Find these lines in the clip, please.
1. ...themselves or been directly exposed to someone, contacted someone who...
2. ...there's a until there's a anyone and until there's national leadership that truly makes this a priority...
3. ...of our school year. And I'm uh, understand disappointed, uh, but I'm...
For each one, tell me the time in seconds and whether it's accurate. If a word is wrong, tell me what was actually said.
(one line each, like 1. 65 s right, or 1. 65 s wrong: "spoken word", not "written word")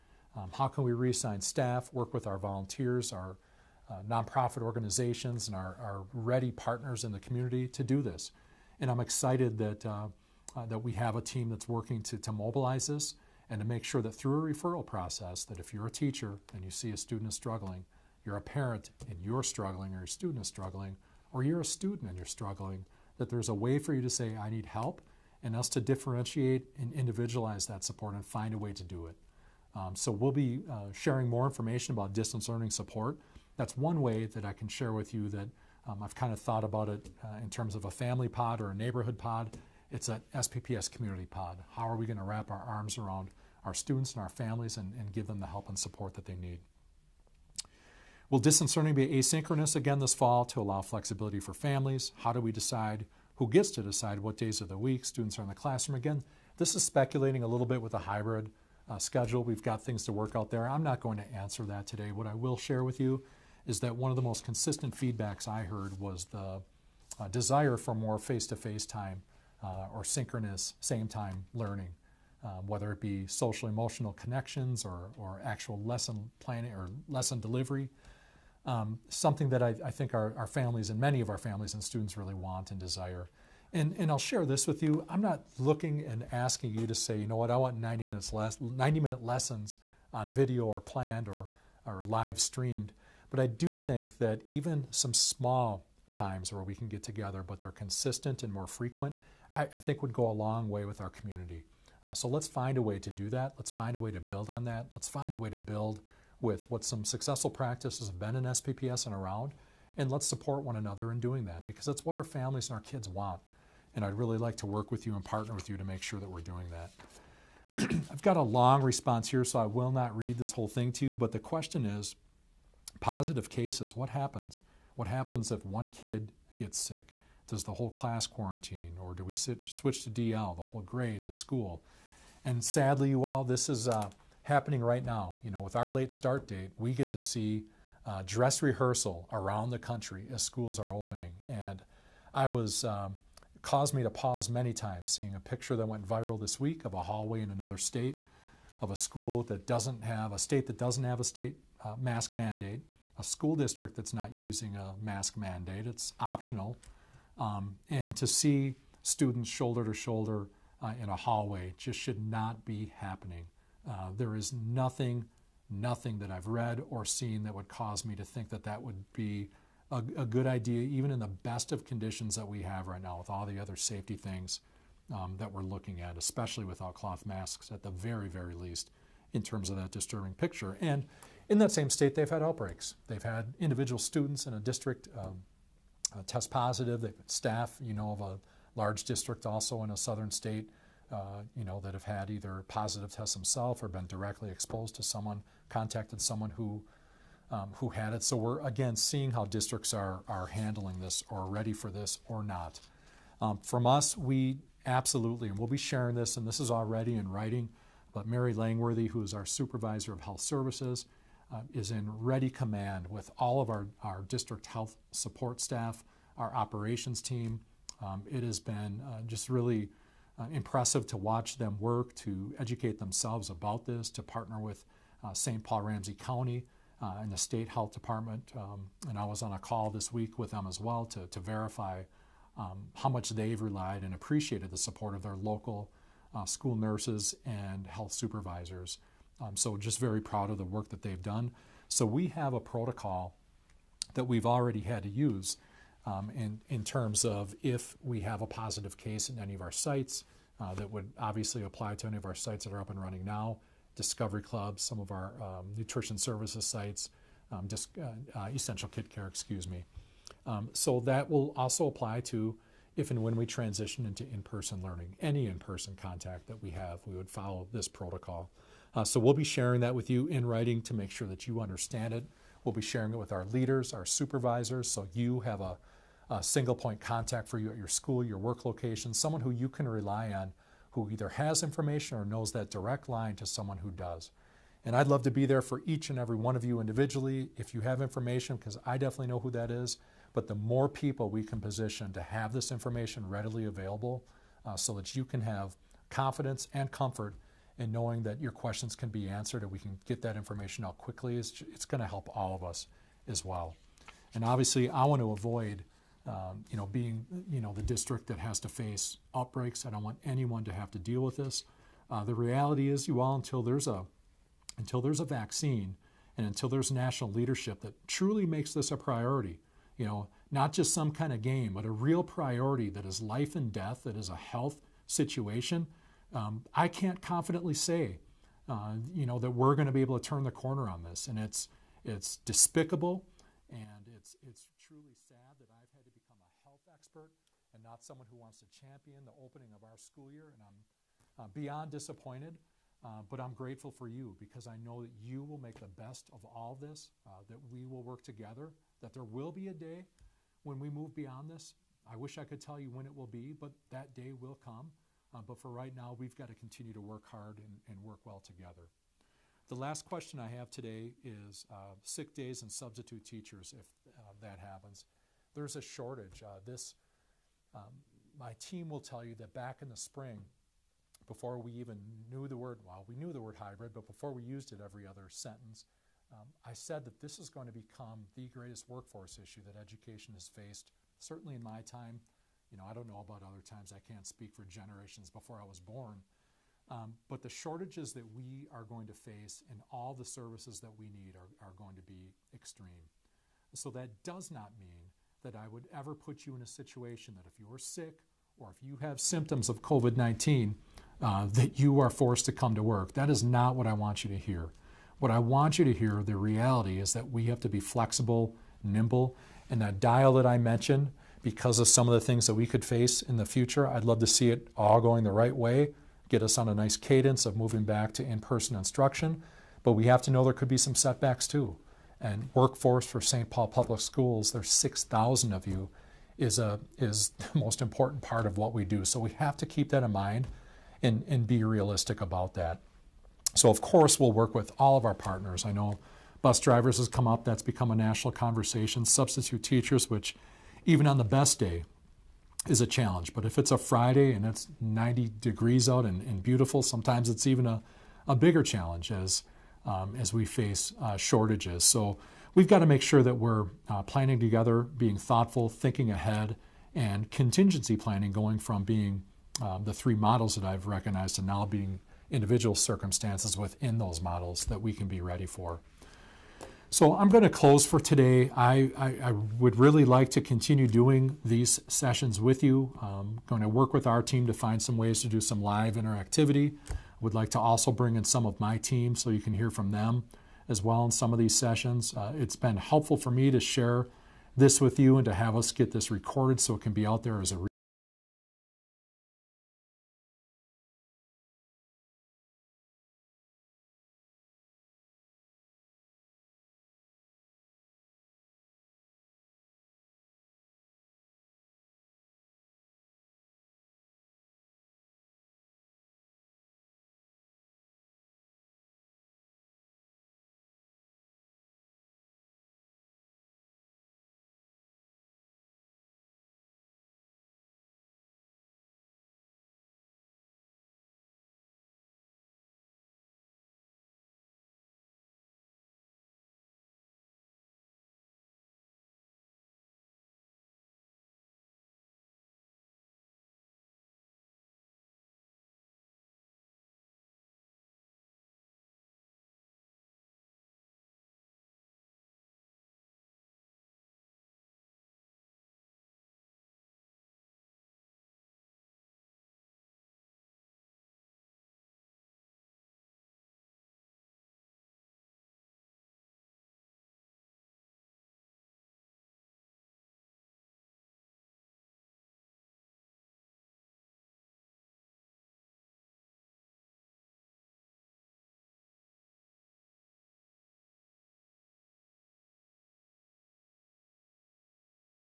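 1. 193 s right
2. 313 s wrong: "vaccine", not "anyone"
3. 339 s wrong: "beyond", not "understand".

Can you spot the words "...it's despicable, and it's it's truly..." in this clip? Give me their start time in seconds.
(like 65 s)
332 s.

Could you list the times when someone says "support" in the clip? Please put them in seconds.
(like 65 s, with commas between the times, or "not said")
27 s, 32 s, 45 s, 110 s, 215 s, 234 s.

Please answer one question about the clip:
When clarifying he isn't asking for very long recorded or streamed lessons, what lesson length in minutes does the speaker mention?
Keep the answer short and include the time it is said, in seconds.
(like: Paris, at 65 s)
90, at 88 s.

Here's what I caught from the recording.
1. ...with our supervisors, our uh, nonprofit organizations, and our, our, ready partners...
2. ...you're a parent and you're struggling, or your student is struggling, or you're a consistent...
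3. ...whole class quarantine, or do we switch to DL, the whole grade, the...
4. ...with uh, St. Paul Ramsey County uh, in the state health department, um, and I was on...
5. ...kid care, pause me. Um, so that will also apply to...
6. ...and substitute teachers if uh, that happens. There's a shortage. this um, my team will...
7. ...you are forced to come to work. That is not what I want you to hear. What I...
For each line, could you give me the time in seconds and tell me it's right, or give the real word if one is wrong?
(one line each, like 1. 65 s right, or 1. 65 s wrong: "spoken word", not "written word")
1. 2 s wrong: "volunteers", not "supervisors"
2. 18 s wrong: "student", not "consistent"
3. 127 s right
4. 224 s right
5. 258 s wrong: "excuse", not "pause"
6. 362 s right
7. 401 s right.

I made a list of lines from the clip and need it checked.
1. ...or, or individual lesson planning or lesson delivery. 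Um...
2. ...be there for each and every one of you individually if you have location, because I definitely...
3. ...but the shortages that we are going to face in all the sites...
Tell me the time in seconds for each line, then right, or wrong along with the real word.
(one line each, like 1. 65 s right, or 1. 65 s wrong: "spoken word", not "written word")
1. 74 s wrong: "actual", not "individual"
2. 285 s wrong: "information", not "location"
3. 387 s wrong: "services", not "sites".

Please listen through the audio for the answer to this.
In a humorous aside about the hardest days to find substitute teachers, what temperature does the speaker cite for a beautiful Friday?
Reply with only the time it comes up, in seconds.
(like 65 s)
444 s.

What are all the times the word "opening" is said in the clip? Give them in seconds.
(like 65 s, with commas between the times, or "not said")
140 s, 339 s.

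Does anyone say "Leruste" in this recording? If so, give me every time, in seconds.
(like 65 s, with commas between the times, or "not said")
not said.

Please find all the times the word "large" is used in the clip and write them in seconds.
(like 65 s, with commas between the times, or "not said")
188 s.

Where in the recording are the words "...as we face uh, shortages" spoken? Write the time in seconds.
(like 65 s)
450 s.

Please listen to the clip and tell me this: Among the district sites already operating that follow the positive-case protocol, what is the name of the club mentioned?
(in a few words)
Discovery Club.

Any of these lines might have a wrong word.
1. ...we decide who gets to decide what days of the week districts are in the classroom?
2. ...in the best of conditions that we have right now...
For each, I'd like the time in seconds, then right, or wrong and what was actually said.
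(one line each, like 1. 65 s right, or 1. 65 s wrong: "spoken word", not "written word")
1. 52 s wrong: "students", not "districts"
2. 171 s right.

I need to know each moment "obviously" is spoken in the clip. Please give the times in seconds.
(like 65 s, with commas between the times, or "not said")
251 s, 304 s.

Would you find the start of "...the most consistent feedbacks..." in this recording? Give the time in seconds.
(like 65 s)
64 s.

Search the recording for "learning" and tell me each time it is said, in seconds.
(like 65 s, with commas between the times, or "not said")
32 s, 48 s, 71 s, 264 s.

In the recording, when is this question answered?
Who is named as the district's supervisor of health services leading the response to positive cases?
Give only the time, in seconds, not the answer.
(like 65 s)
208 s.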